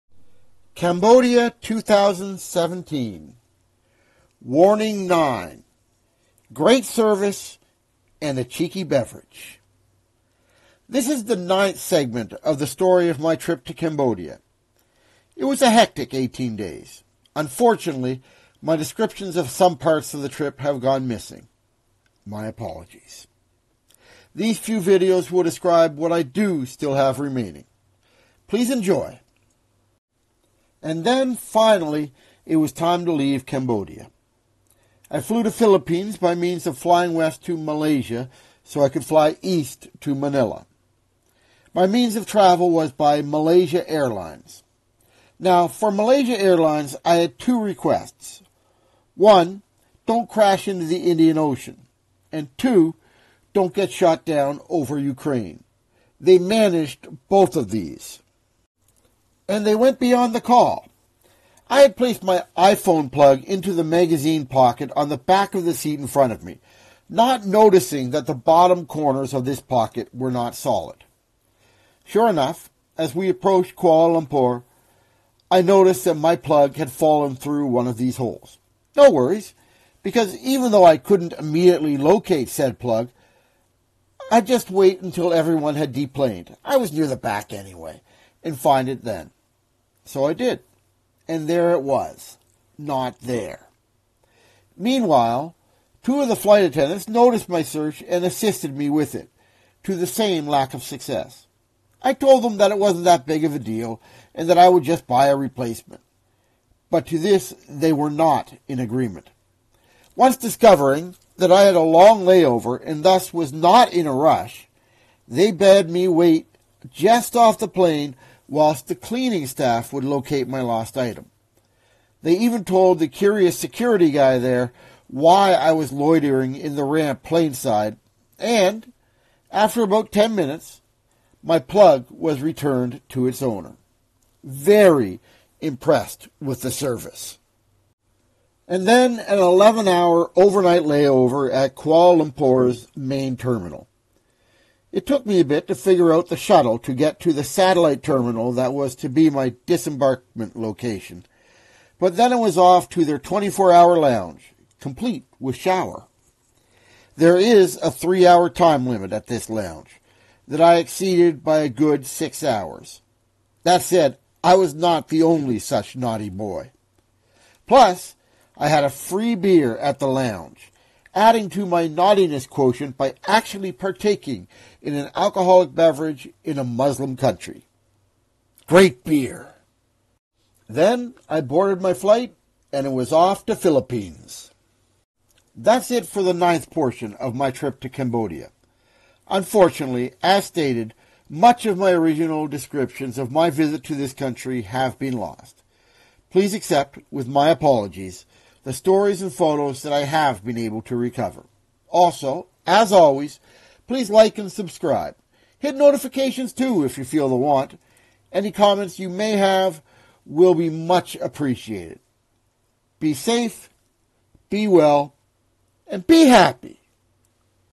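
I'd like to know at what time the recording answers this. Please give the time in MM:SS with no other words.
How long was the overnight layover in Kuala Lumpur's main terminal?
02:19.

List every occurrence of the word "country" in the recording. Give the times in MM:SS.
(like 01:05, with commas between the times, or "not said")
02:57, 03:14.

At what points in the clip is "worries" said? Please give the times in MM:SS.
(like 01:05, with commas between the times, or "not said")
01:19.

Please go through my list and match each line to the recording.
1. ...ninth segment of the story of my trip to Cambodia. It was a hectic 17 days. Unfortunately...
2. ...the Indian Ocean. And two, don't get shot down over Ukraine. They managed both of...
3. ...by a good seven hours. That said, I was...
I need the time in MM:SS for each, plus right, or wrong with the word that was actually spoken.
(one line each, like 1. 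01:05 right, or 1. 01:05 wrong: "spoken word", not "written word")
1. 00:11 wrong: "18", not "17"
2. 00:50 right
3. 02:41 wrong: "six", not "seven".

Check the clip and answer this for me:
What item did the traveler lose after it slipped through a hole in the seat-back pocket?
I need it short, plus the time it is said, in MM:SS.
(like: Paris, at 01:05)
iPhone plug, at 01:02.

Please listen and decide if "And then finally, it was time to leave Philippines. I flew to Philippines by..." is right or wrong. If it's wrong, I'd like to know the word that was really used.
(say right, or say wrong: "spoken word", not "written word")
wrong: "Cambodia", not "Philippines".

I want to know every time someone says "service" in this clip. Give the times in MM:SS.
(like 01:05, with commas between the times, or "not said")
00:06, 02:16.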